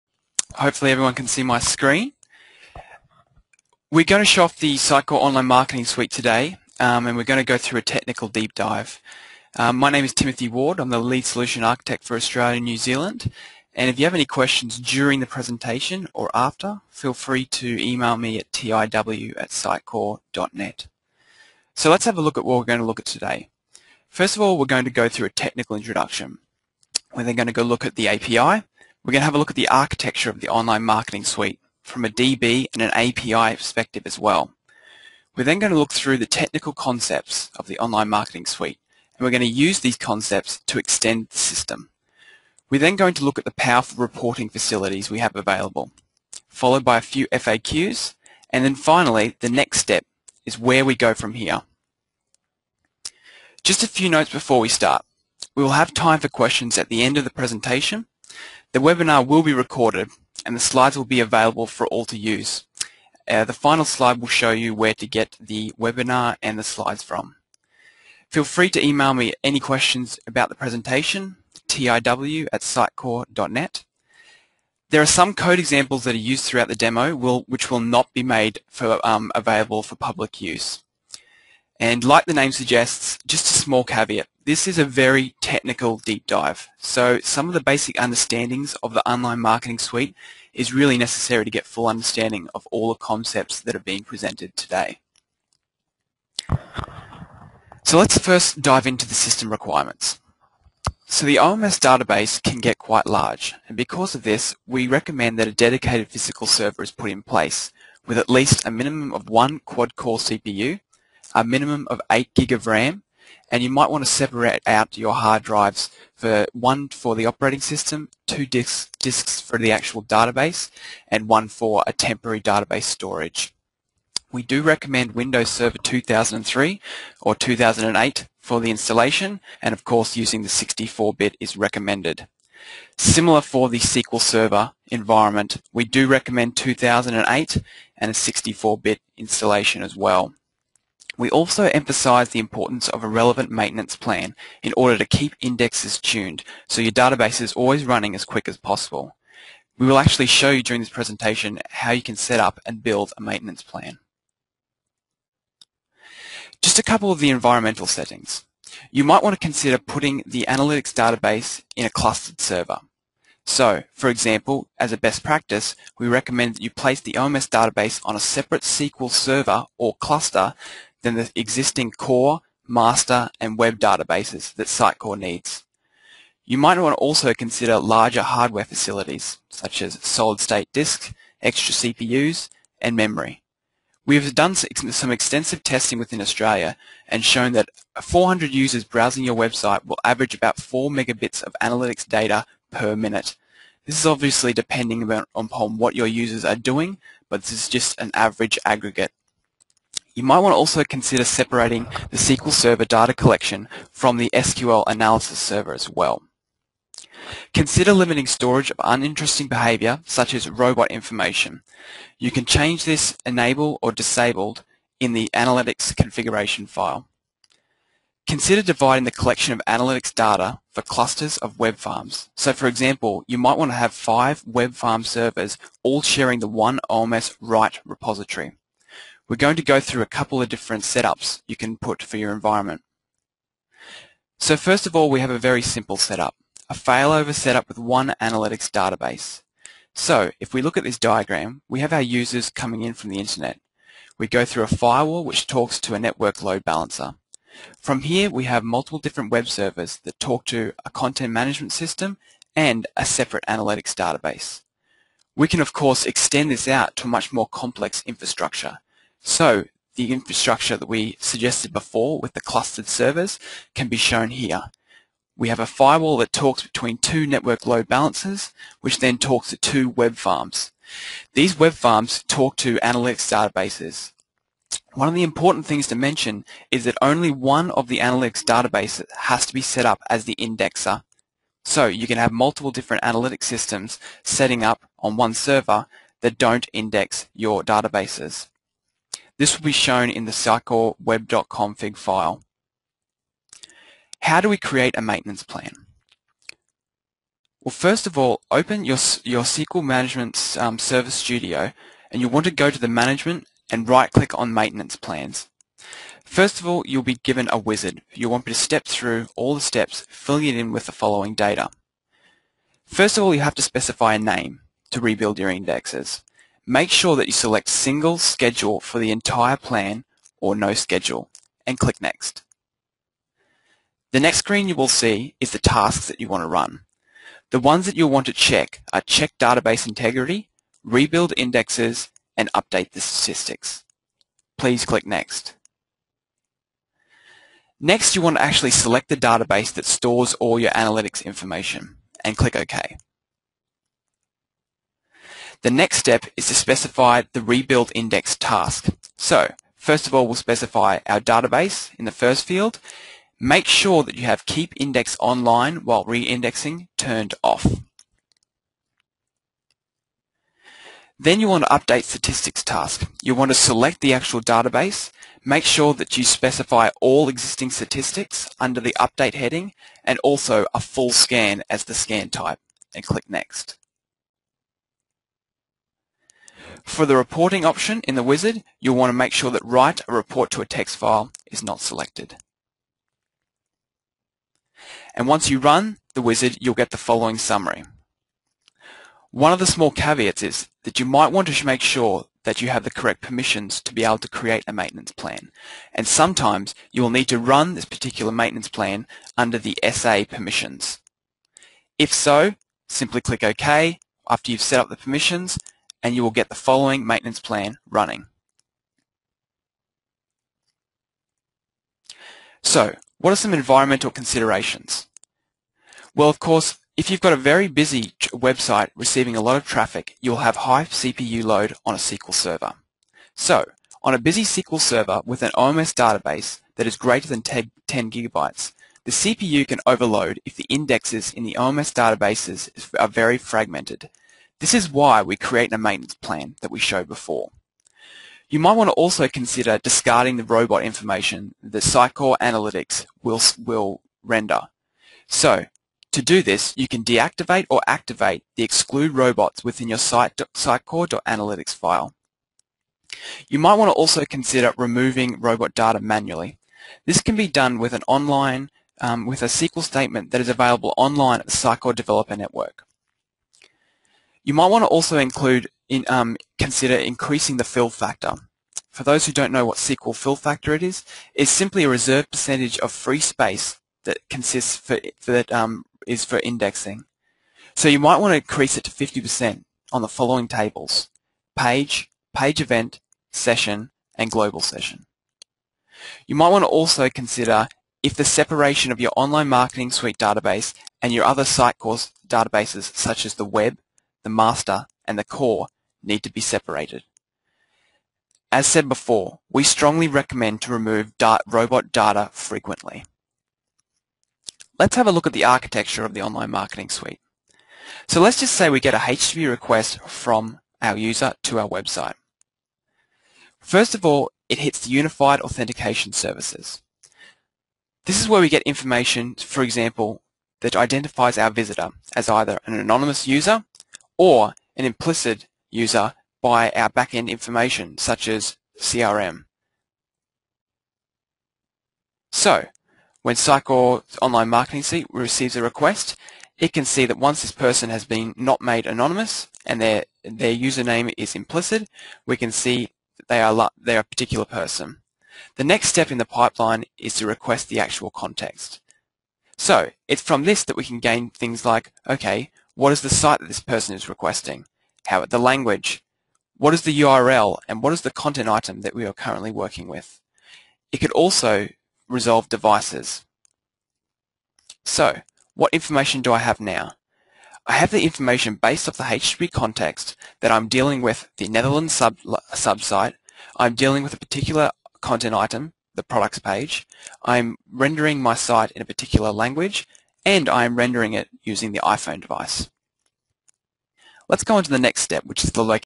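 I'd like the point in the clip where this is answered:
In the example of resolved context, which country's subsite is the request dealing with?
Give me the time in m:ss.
9:31.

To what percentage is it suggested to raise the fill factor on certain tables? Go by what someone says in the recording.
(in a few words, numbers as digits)
50%.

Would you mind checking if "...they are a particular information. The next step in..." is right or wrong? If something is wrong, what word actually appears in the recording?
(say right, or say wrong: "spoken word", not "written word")
wrong: "person", not "information".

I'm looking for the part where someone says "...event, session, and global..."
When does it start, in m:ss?
8:02.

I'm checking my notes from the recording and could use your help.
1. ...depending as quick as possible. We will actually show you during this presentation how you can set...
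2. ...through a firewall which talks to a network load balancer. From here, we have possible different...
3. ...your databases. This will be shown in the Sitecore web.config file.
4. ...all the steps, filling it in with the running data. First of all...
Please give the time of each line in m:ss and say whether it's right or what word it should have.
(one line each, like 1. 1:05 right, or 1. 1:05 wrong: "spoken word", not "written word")
1. 2:27 wrong: "running", not "depending"
2. 4:04 wrong: "multiple", not "possible"
3. 4:47 right
4. 5:09 wrong: "following", not "running".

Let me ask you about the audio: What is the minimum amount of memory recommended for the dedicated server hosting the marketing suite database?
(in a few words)
8 gig.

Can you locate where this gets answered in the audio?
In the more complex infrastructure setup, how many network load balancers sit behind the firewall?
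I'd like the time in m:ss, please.
4:26.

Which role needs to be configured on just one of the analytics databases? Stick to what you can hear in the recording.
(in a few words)
the indexer.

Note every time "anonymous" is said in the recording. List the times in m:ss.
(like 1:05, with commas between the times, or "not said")
8:42, 8:58.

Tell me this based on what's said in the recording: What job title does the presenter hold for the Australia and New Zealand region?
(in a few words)
Lead Solution Architect.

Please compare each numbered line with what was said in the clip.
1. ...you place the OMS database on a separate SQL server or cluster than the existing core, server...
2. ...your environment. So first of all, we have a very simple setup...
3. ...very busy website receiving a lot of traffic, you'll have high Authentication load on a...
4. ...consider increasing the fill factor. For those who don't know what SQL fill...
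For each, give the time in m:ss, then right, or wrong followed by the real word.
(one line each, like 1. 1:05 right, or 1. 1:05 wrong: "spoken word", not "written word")
1. 2:46 wrong: "master", not "server"
2. 3:52 right
3. 6:57 wrong: "CPU", not "Authentication"
4. 7:46 right.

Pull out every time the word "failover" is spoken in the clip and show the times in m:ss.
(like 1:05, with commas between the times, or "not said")
3:56.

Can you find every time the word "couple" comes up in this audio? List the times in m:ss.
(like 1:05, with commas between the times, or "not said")
2:36, 3:50.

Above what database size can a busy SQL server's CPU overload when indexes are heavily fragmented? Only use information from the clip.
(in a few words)
10 gigabytes.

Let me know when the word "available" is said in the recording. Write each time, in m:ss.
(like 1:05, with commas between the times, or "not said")
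0:45, 1:01, 1:19, 7:40.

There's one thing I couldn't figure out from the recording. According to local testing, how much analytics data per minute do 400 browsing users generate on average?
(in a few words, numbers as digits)
4 megabits.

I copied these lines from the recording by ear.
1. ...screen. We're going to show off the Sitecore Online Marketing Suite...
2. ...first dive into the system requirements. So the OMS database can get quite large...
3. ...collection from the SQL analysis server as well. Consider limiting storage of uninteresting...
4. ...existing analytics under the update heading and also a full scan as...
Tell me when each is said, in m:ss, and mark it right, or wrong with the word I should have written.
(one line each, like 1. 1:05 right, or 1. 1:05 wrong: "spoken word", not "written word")
1. 0:01 right
2. 1:38 right
3. 3:23 right
4. 6:07 wrong: "statistics", not "analytics".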